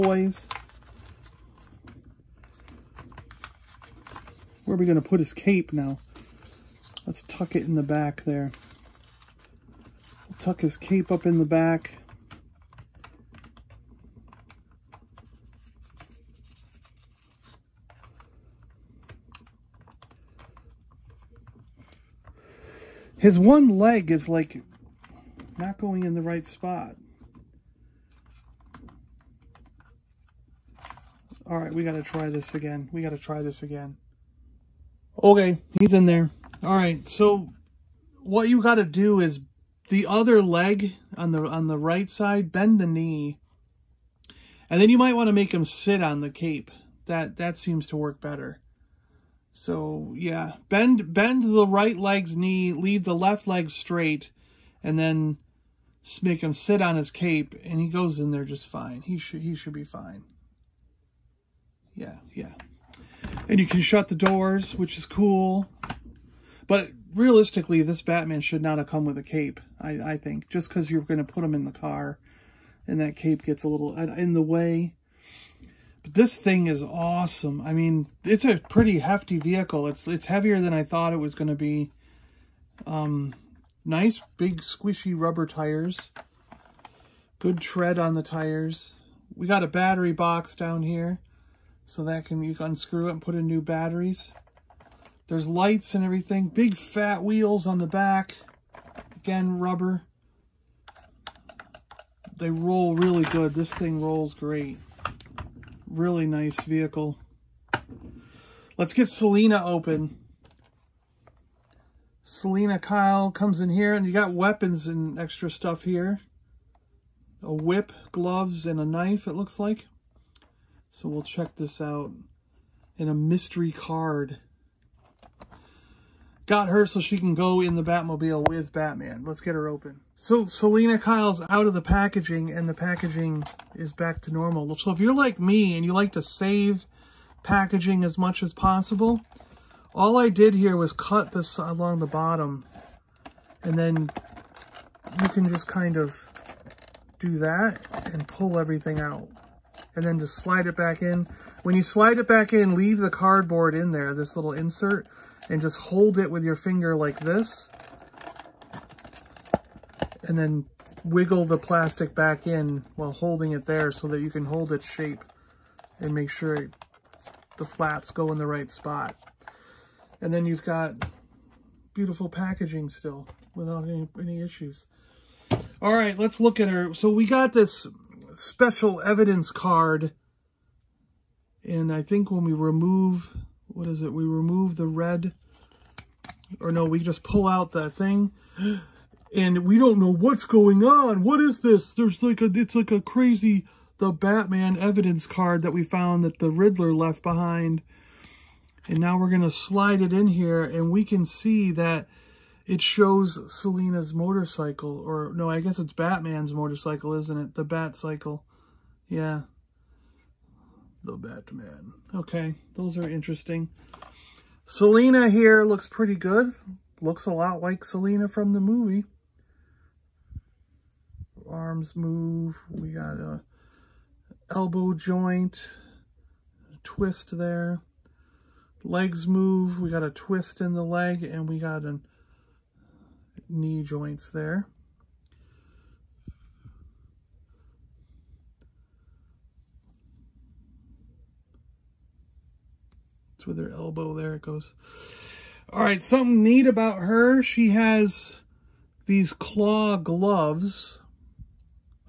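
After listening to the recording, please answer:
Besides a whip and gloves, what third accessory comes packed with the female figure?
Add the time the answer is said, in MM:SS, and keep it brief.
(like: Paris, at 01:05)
A knife, at 01:58.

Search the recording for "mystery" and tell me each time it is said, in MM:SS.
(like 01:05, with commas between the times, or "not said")
02:03.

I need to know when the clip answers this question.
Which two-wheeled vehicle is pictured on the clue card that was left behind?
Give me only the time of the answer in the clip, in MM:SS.
03:27.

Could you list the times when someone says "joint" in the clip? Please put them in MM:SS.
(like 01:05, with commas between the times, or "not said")
03:44, 03:53.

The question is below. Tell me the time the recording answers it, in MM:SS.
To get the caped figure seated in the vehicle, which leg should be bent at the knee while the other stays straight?
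00:51.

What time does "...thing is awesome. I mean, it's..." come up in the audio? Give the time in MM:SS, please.
01:16.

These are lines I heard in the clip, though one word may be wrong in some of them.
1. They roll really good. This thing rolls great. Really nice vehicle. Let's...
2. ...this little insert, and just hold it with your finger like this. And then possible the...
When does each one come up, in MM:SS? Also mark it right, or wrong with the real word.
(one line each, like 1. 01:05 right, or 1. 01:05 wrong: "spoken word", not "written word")
1. 01:42 right
2. 02:34 wrong: "wiggle", not "possible".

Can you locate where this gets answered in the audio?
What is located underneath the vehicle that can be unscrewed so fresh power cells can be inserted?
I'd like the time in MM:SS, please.
01:29.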